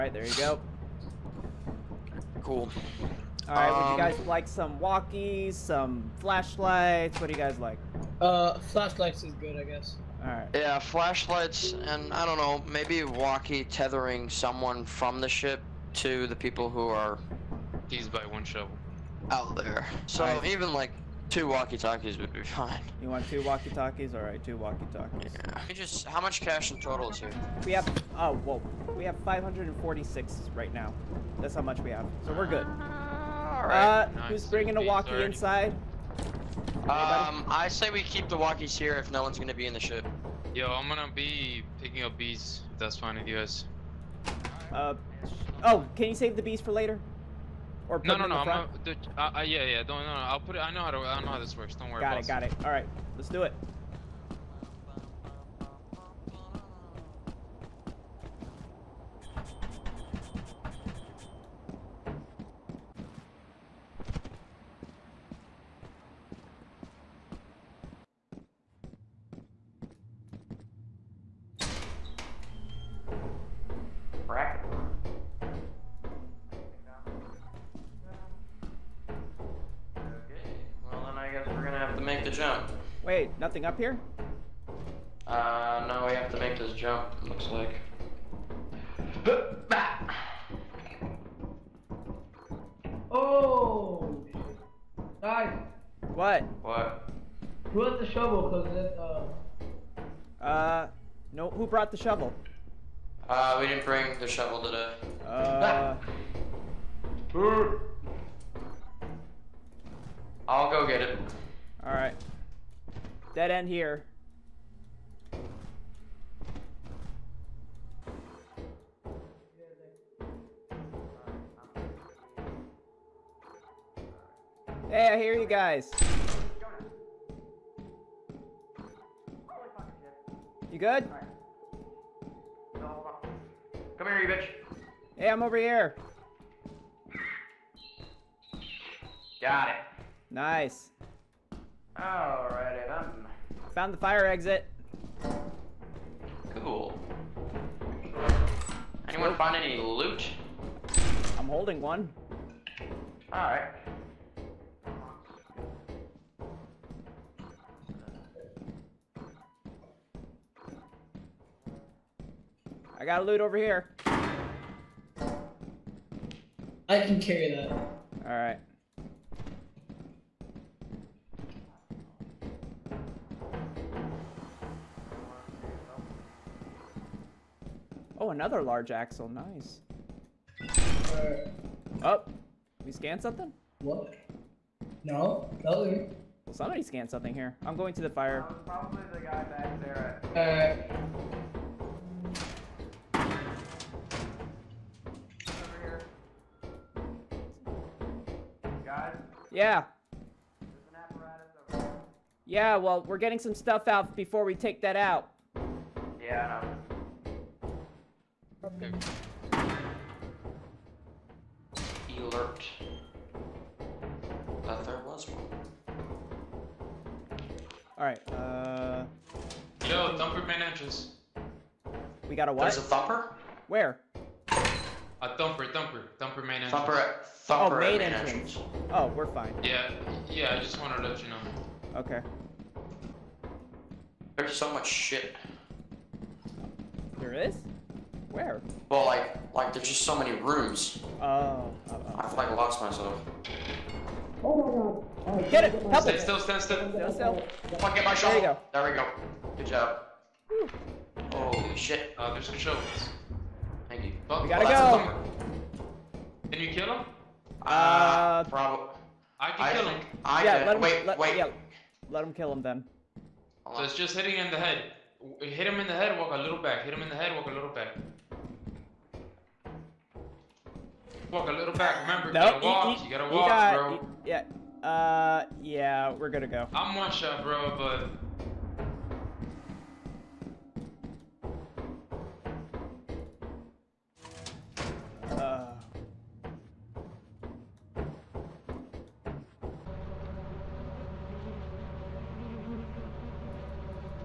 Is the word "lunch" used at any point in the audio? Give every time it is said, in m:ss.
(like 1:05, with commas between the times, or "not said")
not said.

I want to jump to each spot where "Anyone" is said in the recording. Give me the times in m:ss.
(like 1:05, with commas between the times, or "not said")
2:29.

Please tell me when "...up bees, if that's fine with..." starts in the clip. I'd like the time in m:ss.
0:42.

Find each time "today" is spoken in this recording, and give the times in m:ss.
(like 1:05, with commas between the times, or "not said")
1:44.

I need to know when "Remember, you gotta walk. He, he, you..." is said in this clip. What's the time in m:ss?
4:32.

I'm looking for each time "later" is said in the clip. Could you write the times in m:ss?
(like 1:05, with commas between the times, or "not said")
0:46.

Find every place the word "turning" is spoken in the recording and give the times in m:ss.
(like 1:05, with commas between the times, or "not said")
not said.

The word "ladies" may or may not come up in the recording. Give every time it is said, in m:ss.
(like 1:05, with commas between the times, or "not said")
not said.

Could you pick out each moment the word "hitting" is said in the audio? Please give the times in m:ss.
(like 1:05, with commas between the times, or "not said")
4:24.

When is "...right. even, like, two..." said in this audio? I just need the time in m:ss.
0:20.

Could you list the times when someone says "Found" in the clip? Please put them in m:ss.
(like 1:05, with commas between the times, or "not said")
2:23.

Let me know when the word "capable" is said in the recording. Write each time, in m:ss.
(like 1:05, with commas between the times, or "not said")
not said.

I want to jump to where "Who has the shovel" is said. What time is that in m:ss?
1:37.